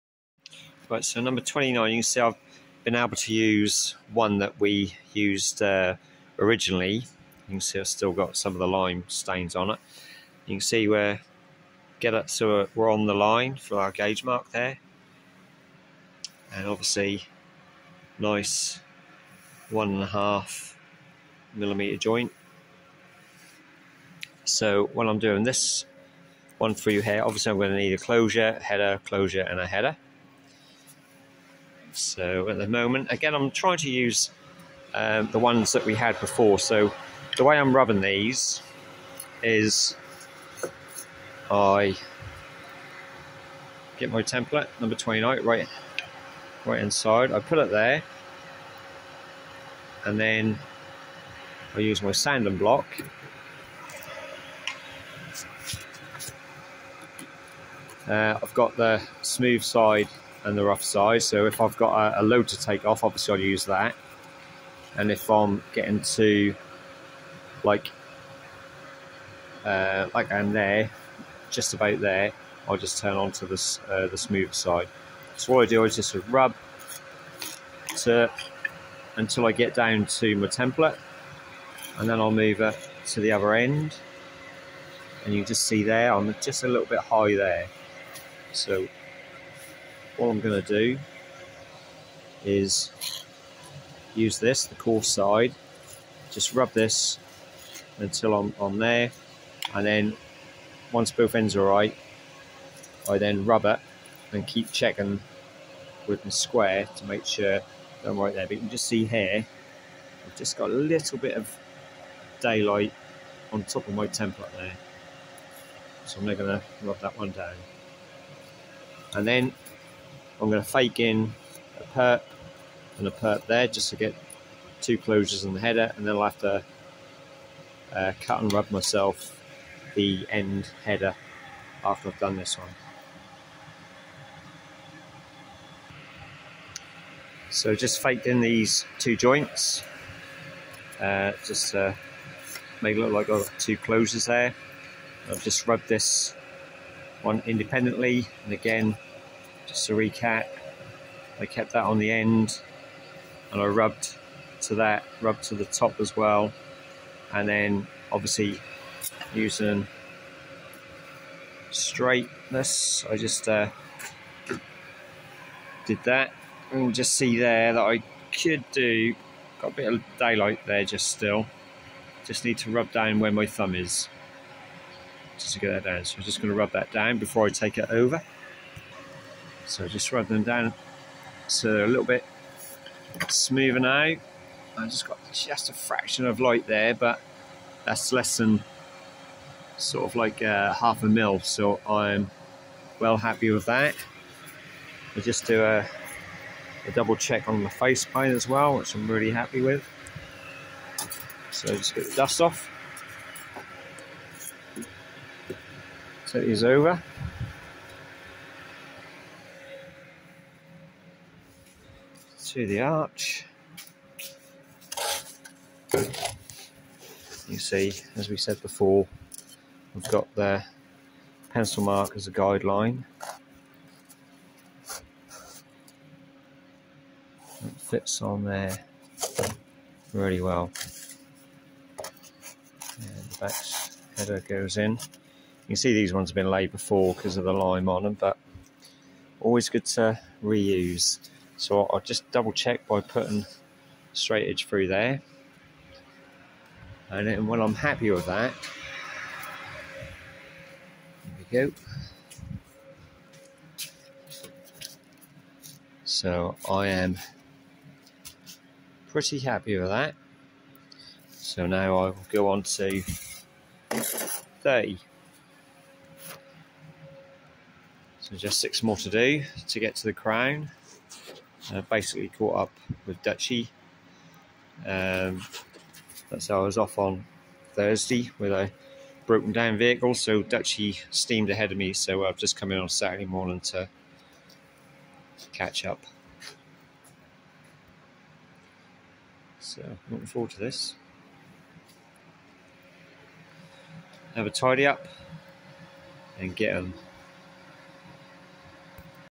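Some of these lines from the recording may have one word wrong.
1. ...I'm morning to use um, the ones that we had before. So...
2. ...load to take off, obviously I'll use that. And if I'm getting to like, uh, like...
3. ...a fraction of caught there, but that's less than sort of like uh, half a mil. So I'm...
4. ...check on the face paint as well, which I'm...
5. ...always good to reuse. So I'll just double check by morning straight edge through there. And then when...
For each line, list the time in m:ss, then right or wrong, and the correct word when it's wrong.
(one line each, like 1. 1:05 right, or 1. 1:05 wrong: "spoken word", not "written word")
1. 0:33 wrong: "trying", not "morning"
2. 1:02 right
3. 3:05 wrong: "light", not "caught"
4. 3:17 right
5. 3:59 wrong: "putting", not "morning".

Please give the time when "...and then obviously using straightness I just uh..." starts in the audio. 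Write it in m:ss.
2:37.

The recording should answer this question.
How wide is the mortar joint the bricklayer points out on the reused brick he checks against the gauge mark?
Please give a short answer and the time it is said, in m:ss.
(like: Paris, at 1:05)
1.5 millimeters, at 0:19.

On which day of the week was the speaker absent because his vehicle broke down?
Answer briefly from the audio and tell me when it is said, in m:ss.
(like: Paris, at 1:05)
Thursday, at 4:37.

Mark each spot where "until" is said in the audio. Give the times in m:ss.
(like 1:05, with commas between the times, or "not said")
1:19, 1:37.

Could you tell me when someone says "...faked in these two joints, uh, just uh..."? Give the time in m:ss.
2:18.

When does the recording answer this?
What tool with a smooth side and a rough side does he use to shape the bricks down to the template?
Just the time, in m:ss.
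0:52.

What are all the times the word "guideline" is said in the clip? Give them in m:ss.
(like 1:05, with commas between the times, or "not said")
3:42.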